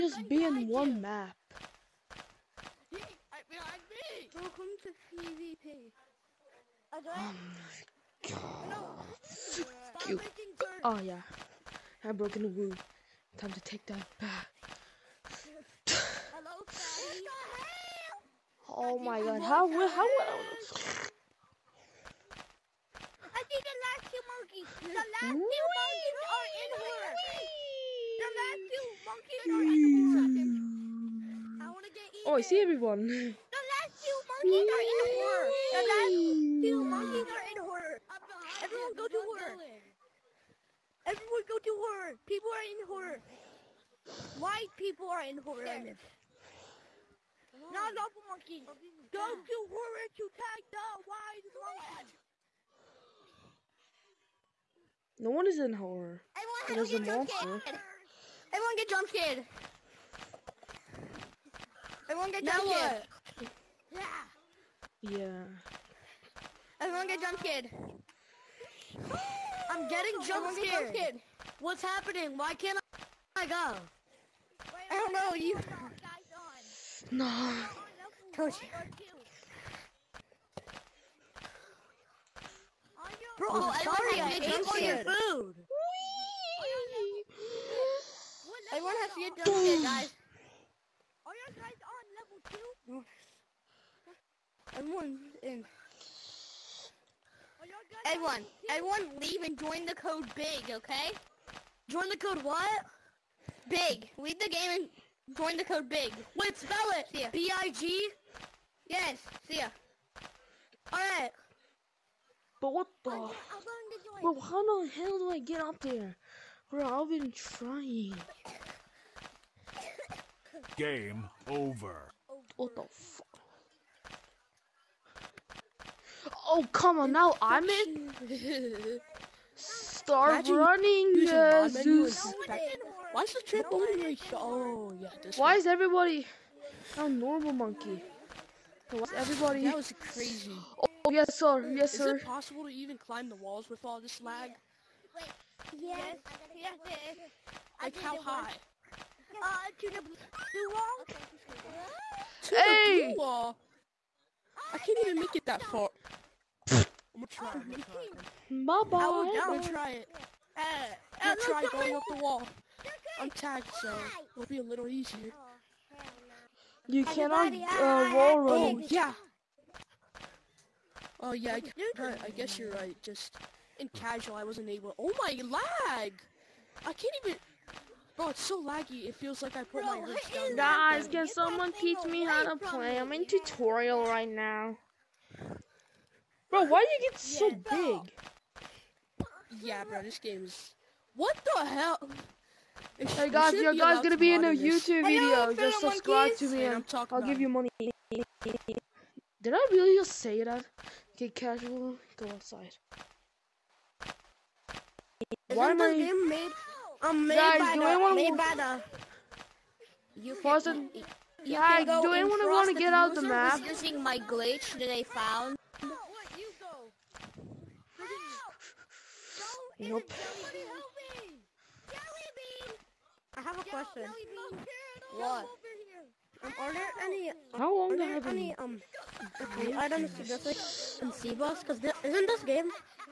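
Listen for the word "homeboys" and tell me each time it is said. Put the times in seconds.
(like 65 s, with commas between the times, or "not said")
not said.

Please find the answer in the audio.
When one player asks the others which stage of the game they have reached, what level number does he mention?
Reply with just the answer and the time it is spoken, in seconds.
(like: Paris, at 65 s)
2, at 94 s.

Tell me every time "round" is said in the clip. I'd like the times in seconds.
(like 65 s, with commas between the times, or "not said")
not said.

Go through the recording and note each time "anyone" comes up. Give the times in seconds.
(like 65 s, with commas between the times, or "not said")
207 s, 212 s.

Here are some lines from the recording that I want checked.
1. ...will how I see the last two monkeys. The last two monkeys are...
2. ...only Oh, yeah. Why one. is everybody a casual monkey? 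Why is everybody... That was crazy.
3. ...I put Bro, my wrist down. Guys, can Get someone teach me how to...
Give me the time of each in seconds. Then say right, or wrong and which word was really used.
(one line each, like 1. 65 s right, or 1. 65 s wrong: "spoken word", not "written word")
1. 20 s right
2. 133 s wrong: "normal", not "casual"
3. 179 s right.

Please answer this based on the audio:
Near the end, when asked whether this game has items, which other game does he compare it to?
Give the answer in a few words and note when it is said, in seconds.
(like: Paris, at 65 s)
Seaboss, at 231 s.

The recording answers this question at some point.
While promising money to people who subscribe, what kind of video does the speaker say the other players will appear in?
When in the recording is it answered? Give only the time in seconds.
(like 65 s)
194 s.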